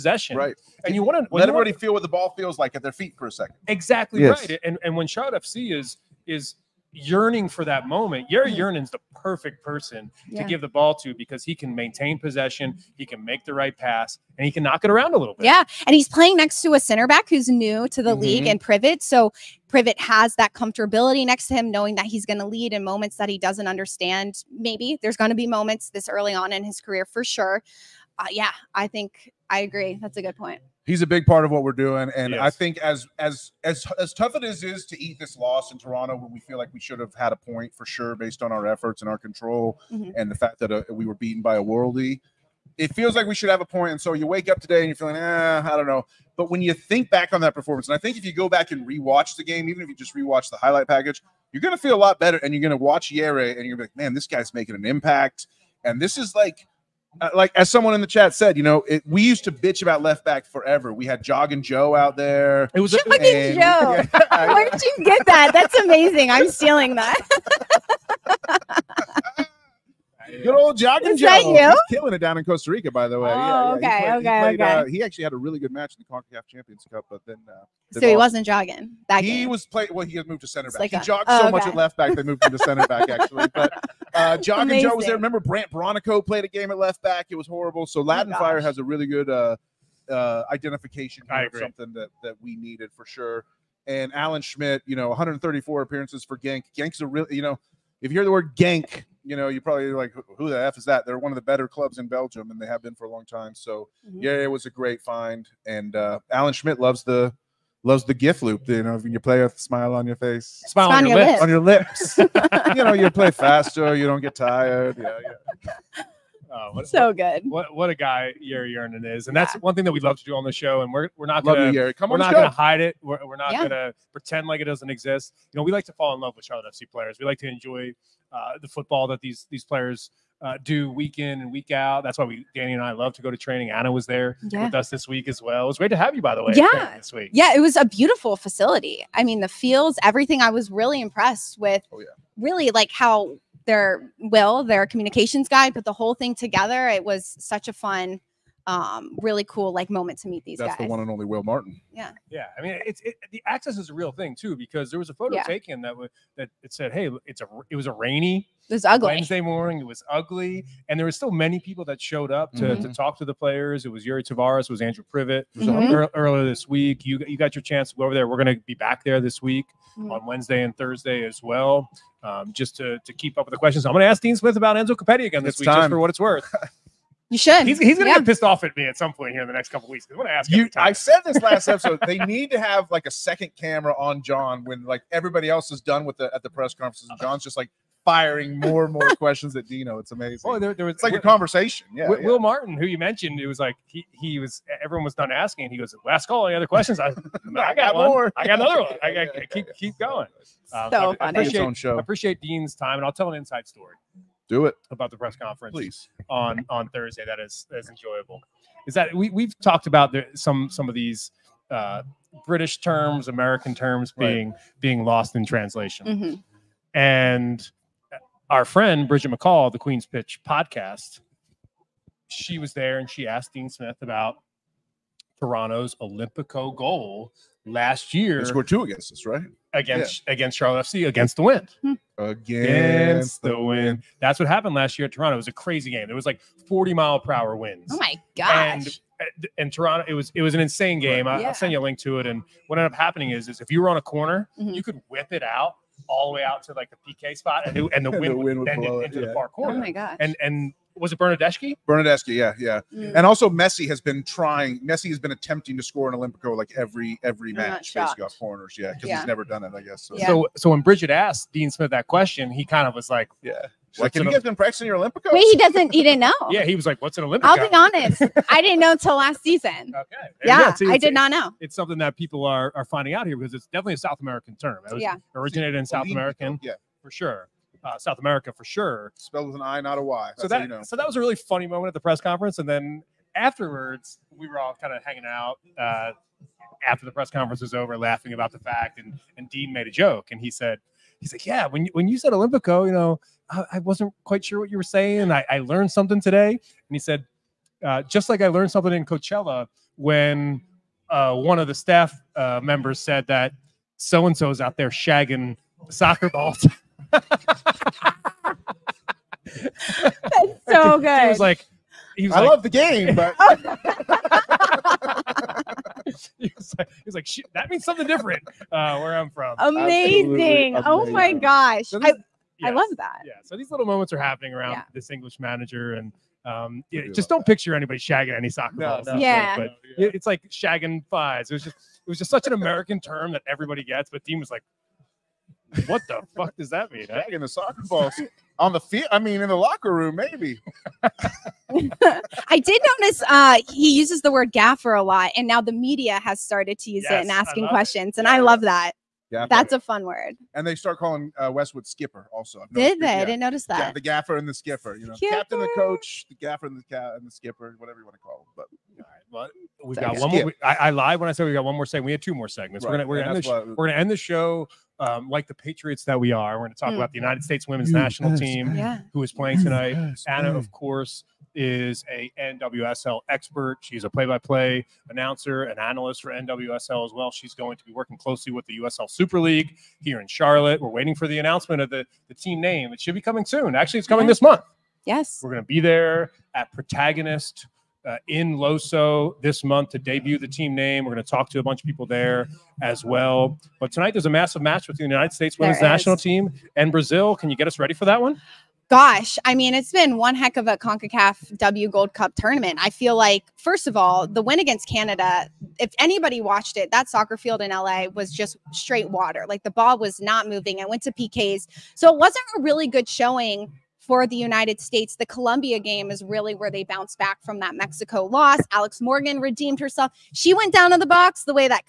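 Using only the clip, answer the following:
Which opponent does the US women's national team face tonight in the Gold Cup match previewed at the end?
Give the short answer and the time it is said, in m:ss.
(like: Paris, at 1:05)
Brazil, at 6:36.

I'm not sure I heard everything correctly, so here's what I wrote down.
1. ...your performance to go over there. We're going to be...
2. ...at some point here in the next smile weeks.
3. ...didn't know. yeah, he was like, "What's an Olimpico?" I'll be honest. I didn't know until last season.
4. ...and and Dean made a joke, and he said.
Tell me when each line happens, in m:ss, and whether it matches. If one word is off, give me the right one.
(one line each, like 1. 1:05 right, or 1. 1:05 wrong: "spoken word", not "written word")
1. 2:47 wrong: "chance", not "performance"
2. 2:58 wrong: "couple", not "smile"
3. 4:26 right
4. 4:48 right.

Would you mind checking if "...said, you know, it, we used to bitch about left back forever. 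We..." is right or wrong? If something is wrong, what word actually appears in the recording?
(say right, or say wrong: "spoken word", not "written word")
right.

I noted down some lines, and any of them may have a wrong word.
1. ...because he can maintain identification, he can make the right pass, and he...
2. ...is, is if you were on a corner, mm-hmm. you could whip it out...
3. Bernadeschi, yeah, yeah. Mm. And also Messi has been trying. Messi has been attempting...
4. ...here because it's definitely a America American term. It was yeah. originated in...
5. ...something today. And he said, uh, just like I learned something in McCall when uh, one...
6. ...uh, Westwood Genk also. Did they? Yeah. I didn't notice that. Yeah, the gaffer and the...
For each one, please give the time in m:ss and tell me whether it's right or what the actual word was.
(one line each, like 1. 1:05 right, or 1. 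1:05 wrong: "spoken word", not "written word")
1. 0:11 wrong: "possession", not "identification"
2. 4:03 right
3. 4:11 right
4. 4:33 wrong: "South", not "America"
5. 4:55 wrong: "Coachella", not "McCall"
6. 5:51 wrong: "Skipper", not "Genk".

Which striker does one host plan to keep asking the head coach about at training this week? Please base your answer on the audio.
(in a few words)
Enzo Copetti.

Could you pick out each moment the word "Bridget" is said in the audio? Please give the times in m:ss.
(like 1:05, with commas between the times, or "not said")
3:39, 4:20.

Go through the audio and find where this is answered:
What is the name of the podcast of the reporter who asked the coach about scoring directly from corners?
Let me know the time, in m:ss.
3:39.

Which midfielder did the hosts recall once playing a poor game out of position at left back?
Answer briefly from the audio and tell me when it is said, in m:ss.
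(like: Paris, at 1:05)
Brandt Bronico, at 1:25.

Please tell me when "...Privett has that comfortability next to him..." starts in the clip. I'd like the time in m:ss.
0:19.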